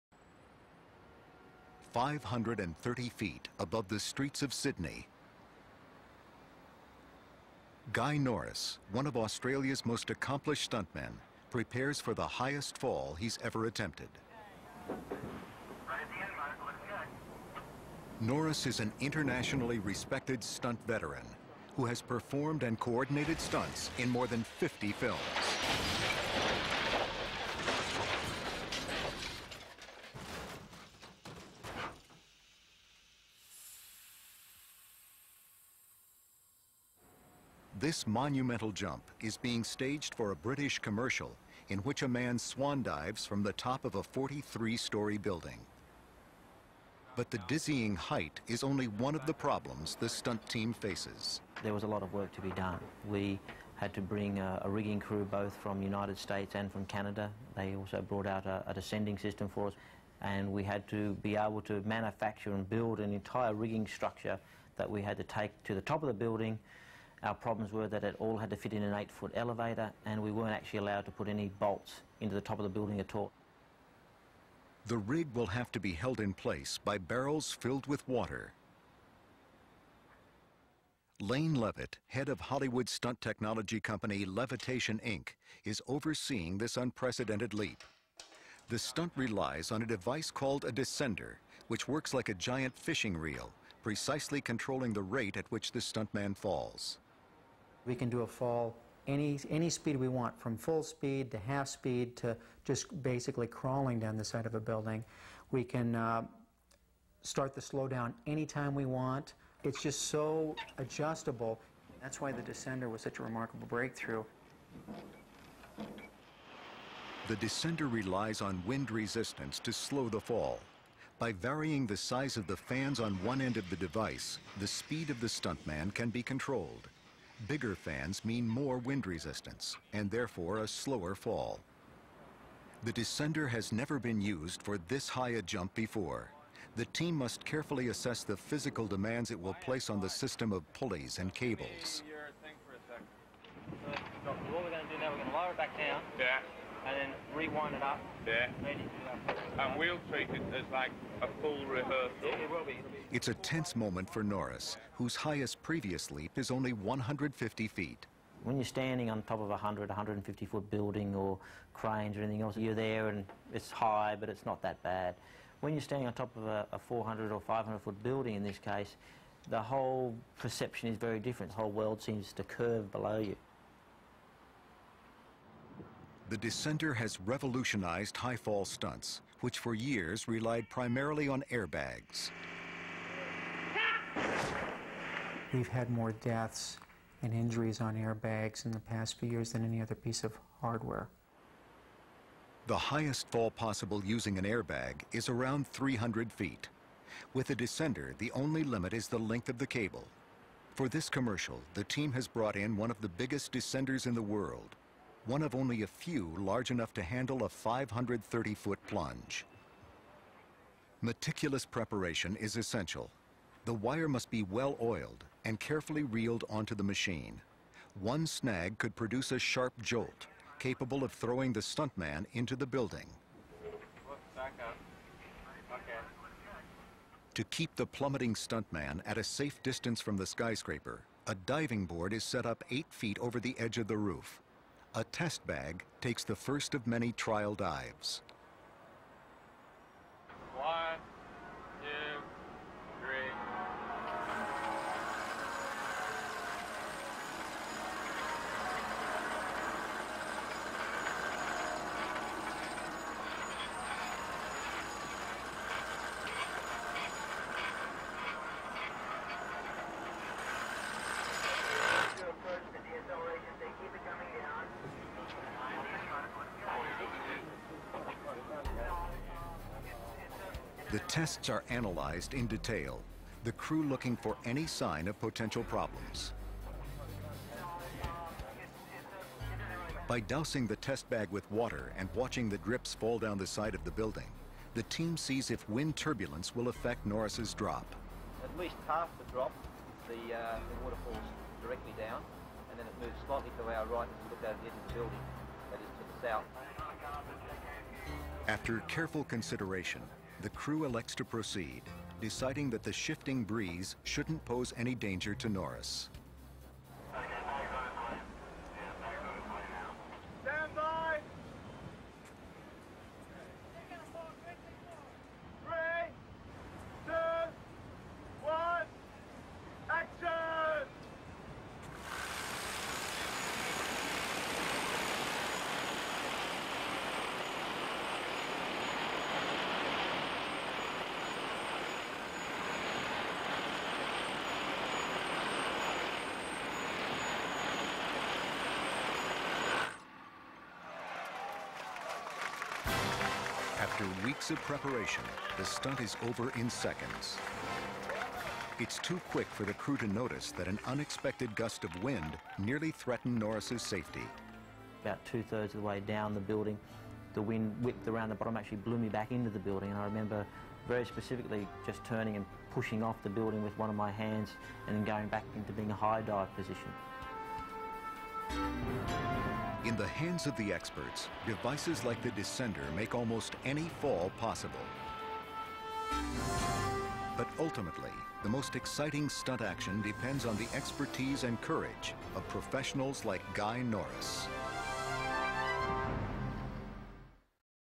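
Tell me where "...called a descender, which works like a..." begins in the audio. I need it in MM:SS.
01:30.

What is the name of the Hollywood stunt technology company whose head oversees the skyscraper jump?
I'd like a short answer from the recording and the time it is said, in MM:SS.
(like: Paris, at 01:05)
Leavitation Inc., at 01:24.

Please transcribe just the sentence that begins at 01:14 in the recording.
The rig will have to be held in place by barrels filled with water.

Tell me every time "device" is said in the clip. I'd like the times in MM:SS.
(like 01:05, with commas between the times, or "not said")
01:29, 02:03, 06:11.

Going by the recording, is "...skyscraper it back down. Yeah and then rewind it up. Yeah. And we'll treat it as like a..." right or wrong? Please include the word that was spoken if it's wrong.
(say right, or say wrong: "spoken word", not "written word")
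wrong: "lower", not "skyscraper".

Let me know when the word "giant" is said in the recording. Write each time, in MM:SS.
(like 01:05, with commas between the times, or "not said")
01:32.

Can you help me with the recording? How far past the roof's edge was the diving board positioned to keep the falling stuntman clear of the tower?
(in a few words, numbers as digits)
eight feet.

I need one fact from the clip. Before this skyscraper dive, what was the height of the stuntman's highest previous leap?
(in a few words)
150 feet.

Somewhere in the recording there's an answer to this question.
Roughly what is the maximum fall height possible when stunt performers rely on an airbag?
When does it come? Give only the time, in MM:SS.
03:15.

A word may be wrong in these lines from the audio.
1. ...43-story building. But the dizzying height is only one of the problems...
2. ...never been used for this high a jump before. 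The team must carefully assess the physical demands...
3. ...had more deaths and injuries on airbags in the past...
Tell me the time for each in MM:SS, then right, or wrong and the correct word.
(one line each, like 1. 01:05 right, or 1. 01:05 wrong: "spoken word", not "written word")
1. 00:44 right
2. 02:13 right
3. 03:05 right.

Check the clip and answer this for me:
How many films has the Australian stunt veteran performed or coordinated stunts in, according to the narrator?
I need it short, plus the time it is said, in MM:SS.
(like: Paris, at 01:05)
more than 50, at 00:24.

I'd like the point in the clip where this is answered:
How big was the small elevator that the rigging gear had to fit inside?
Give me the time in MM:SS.
01:08.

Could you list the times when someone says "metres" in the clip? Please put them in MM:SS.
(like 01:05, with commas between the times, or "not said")
not said.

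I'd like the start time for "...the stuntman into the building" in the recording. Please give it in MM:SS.
03:41.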